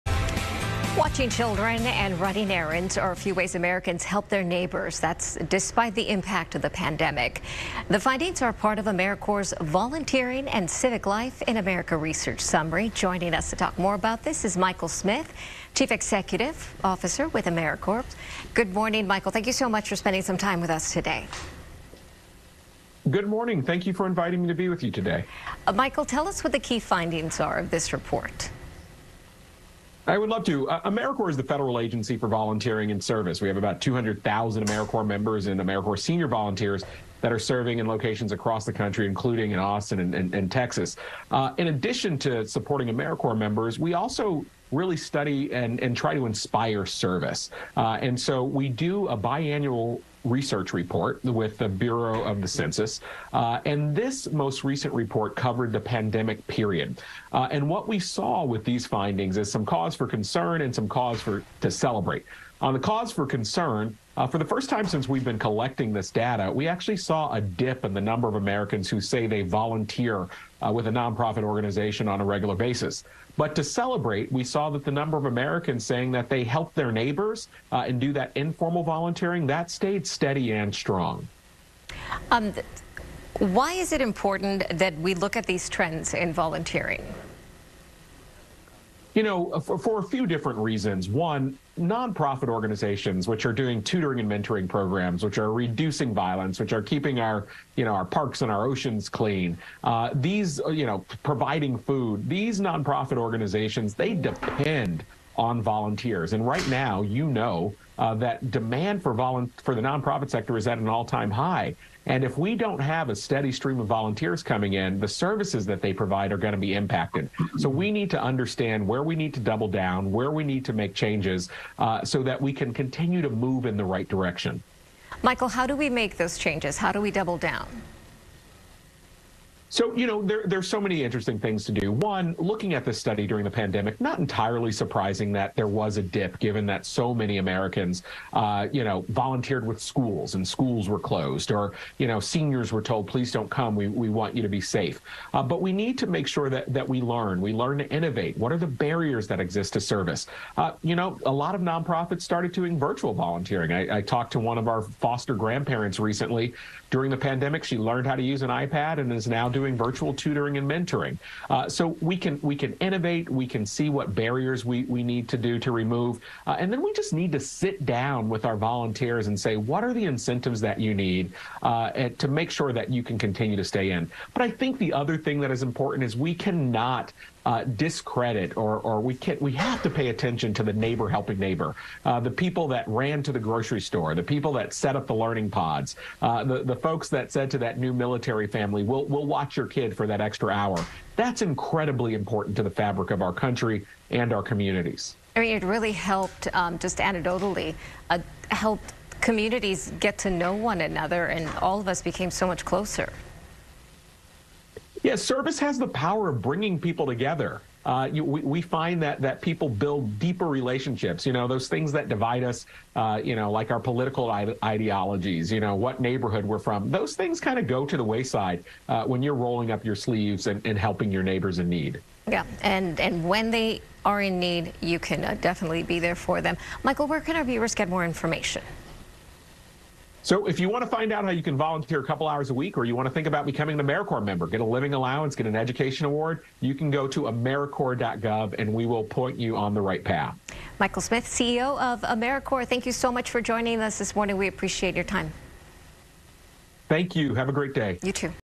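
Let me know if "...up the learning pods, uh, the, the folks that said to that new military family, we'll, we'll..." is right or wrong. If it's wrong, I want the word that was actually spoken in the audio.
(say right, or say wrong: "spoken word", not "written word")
right.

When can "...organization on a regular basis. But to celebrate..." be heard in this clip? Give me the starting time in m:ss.
1:11.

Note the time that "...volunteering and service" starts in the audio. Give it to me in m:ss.
0:32.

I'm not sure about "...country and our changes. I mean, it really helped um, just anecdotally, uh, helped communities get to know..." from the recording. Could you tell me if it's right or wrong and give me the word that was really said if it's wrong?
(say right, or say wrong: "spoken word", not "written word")
wrong: "communities", not "changes".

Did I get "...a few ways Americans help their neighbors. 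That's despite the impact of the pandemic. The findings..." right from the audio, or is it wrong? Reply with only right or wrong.
right.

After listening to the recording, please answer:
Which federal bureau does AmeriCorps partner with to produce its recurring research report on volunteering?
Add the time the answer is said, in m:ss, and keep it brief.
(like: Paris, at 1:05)
Bureau of the Census, at 0:51.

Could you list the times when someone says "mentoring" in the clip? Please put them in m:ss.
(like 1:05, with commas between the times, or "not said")
1:34, 2:40.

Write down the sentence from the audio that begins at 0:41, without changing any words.
Uh, in addition to supporting AmeriCorps members, we also really study and, and try to inspire service.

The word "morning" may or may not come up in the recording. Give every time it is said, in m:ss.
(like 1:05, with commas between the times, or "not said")
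0:18, 0:23, 4:04.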